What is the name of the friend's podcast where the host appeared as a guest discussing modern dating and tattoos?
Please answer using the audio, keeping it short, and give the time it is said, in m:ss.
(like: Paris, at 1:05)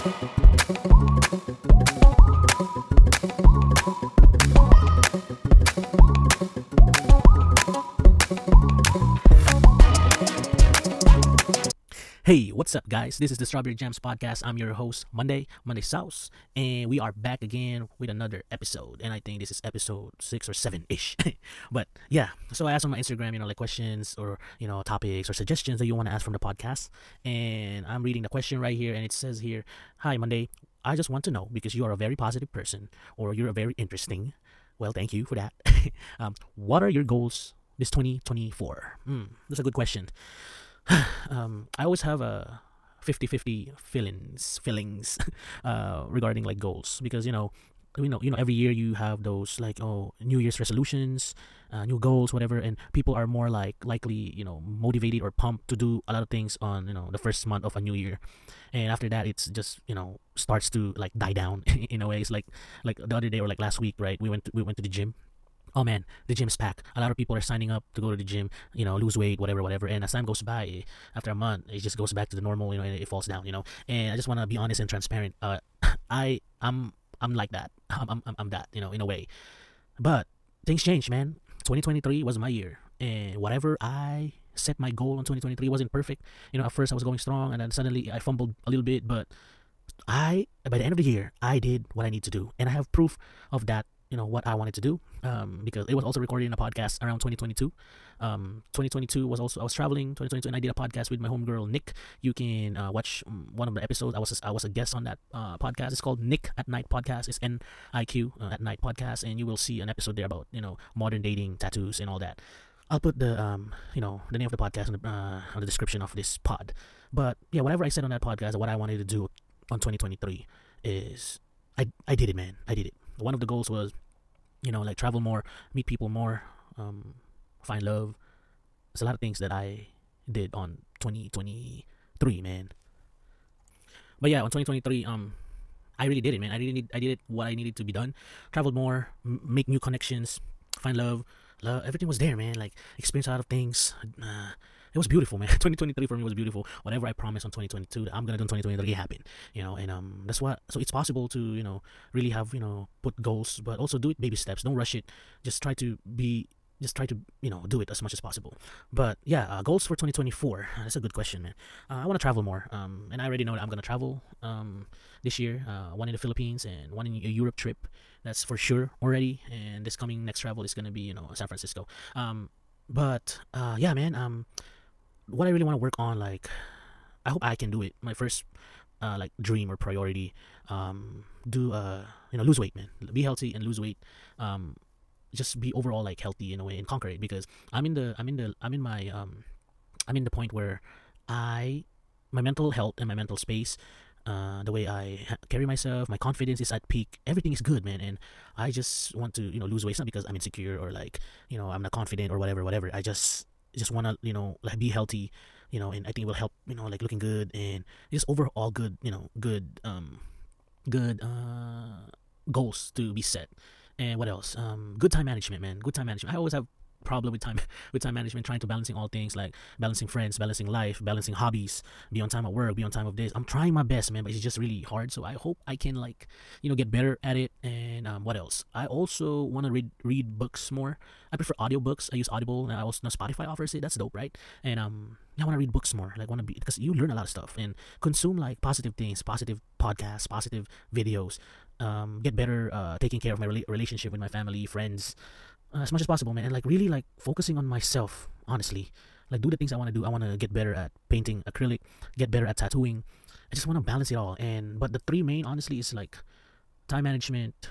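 Niq at Night Podcast, at 1:46.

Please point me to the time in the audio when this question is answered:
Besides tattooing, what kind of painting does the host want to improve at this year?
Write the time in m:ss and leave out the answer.
4:11.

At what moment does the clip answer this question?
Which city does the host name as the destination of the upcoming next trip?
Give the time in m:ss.
2:51.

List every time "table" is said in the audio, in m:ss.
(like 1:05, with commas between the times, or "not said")
not said.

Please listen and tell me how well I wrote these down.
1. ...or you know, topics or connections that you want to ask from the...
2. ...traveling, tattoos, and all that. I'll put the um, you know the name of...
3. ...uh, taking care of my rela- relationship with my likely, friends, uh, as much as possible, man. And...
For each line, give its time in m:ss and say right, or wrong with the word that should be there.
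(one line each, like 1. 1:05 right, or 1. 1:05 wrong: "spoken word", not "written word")
1. 0:24 wrong: "suggestions", not "connections"
2. 1:51 wrong: "dating", not "traveling"
3. 4:02 wrong: "family", not "likely".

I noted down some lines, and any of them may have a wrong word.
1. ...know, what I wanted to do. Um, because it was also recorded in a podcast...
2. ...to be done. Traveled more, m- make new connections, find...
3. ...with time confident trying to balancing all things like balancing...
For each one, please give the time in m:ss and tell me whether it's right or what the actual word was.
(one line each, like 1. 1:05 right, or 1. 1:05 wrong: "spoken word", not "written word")
1. 1:34 right
2. 2:17 right
3. 3:37 wrong: "management", not "confident".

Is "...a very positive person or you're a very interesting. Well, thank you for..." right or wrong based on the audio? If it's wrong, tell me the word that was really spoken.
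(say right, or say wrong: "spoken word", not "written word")
right.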